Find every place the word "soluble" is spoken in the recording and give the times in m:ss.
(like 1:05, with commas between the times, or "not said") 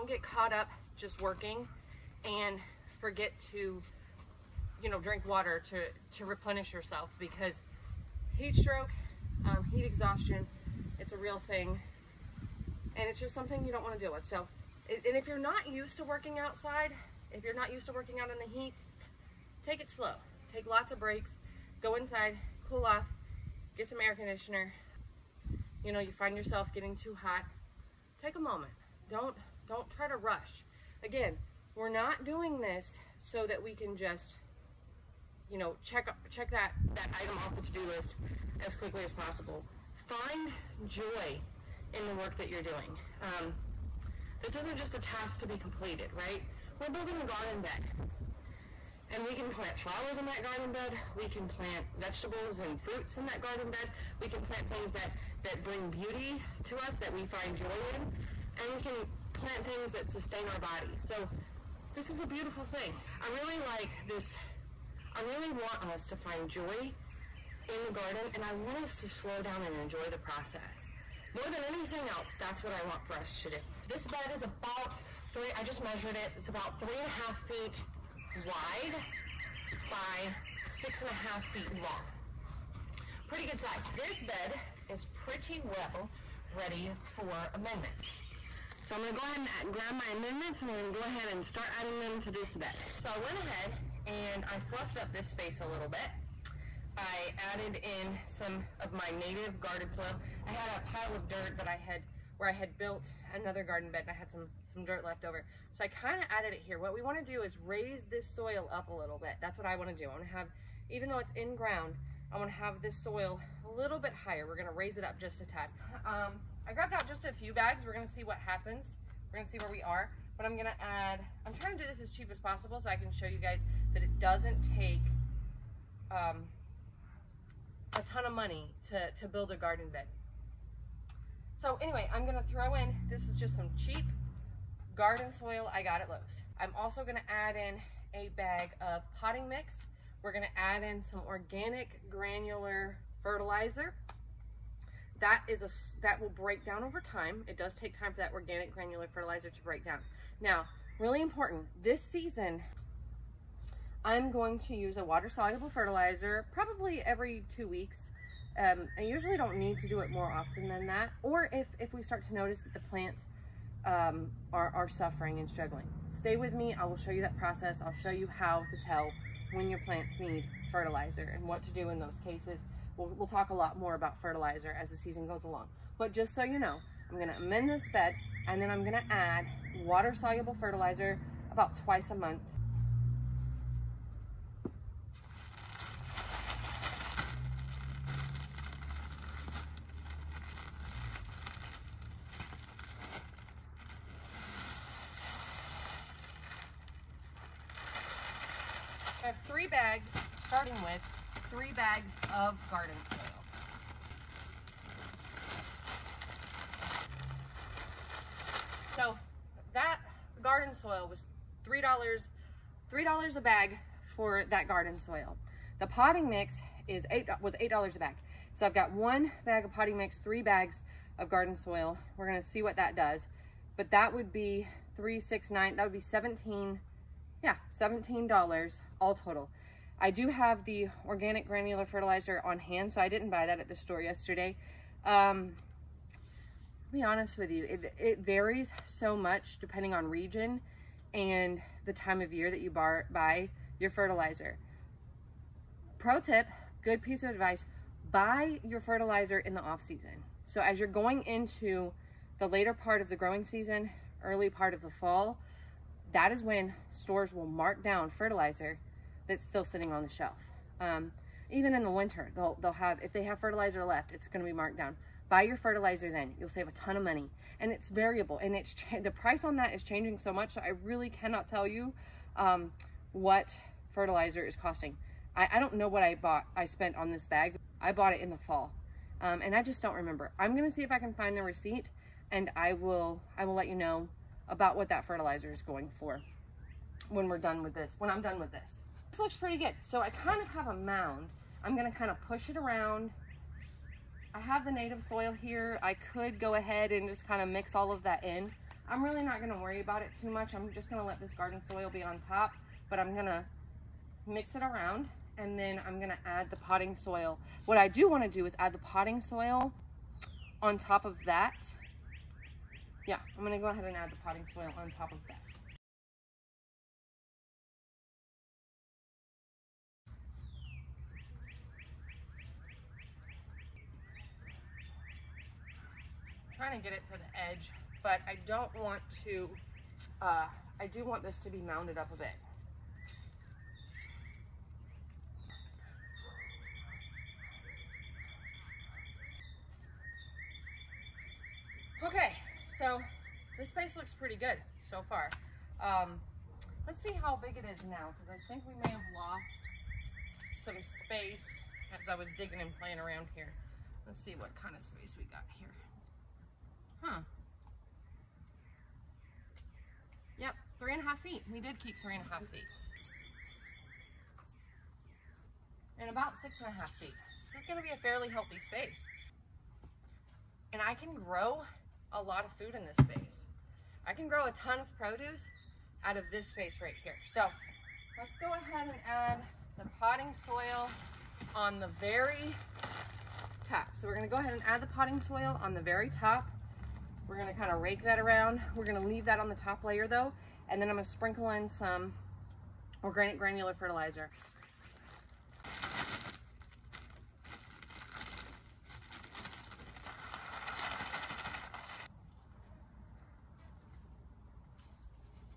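2:35, 2:59.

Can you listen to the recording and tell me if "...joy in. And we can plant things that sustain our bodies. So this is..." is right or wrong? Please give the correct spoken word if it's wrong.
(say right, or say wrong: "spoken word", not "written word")
right.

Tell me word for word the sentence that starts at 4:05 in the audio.
Pro tip, good piece of advice, buy your fertilizer in the off season.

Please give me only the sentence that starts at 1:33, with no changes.
So I went ahead and I fluffed up this space a little bit.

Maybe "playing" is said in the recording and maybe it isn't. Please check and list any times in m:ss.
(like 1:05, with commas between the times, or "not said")
5:52.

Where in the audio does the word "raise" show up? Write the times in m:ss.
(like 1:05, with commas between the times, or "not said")
1:47, 1:54.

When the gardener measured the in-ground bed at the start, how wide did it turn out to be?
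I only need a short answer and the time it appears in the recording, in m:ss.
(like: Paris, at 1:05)
3.5 feet, at 1:16.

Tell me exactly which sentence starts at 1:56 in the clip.
Um, I grabbed out just a few bags.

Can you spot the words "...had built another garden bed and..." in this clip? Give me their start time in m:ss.
1:42.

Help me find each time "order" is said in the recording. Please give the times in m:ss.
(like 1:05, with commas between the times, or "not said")
not said.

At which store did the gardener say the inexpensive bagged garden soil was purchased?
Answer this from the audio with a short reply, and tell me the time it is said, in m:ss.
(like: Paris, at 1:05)
Lowe's, at 2:16.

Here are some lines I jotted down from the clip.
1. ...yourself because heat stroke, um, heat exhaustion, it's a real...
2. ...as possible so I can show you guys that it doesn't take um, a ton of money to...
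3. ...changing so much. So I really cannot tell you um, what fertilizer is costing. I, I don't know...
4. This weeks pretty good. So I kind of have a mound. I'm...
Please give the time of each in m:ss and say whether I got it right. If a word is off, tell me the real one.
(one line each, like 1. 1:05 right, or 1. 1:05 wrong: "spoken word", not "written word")
1. 0:06 right
2. 2:02 right
3. 4:29 right
4. 4:49 wrong: "looks", not "weeks".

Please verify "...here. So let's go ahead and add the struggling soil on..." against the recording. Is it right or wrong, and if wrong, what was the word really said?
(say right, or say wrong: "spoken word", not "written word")
wrong: "potting", not "struggling".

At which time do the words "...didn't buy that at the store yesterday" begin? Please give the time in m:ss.
3:53.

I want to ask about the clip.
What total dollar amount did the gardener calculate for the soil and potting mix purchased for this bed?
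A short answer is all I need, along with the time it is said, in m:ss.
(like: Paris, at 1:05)
$17, at 3:47.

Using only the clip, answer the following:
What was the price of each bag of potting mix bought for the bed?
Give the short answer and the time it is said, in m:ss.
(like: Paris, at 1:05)
$8, at 3:37.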